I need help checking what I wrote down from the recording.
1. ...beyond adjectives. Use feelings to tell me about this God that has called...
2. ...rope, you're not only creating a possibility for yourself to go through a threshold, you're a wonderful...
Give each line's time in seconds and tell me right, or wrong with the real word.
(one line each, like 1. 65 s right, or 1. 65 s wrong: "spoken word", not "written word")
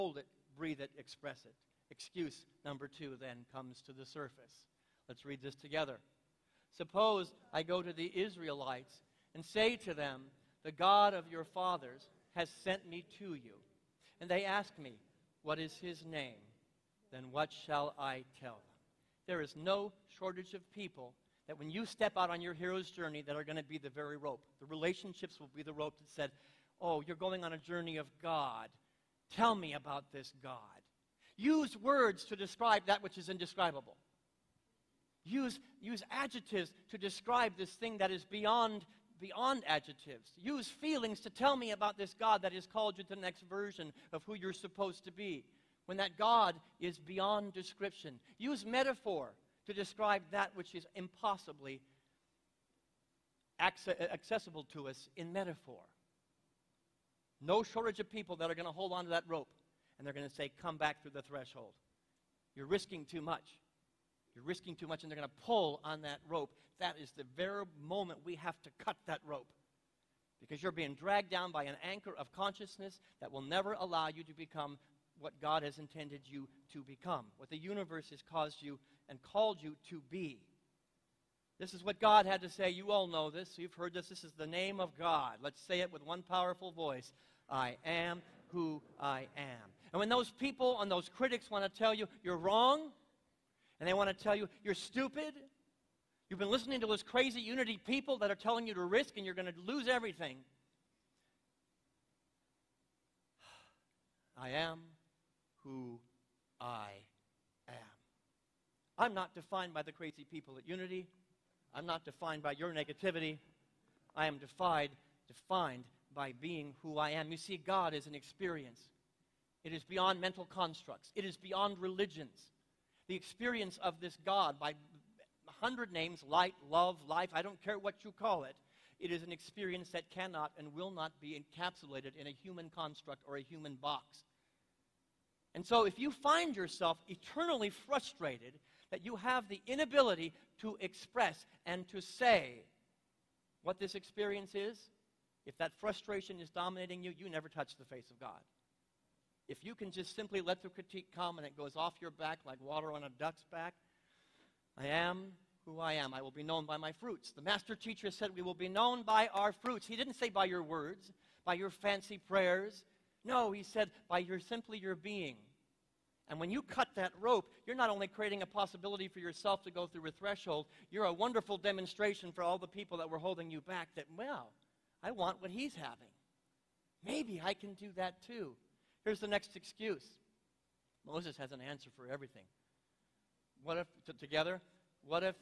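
1. 39 s right
2. 167 s right.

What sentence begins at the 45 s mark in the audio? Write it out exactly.
When that God is beyond description, use metaphor to describe that which is impossibly accessible to us in metaphor.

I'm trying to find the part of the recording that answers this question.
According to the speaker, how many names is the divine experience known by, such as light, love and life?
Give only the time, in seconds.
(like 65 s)
124 s.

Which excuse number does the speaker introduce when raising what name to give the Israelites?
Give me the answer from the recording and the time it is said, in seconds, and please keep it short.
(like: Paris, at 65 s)
2, at 2 s.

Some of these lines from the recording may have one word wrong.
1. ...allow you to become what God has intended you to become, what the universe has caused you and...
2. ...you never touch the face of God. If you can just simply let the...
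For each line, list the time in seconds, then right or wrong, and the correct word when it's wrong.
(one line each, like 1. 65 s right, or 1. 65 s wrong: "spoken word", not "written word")
1. 73 s right
2. 147 s right.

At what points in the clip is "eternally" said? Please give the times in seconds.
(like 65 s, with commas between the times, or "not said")
137 s.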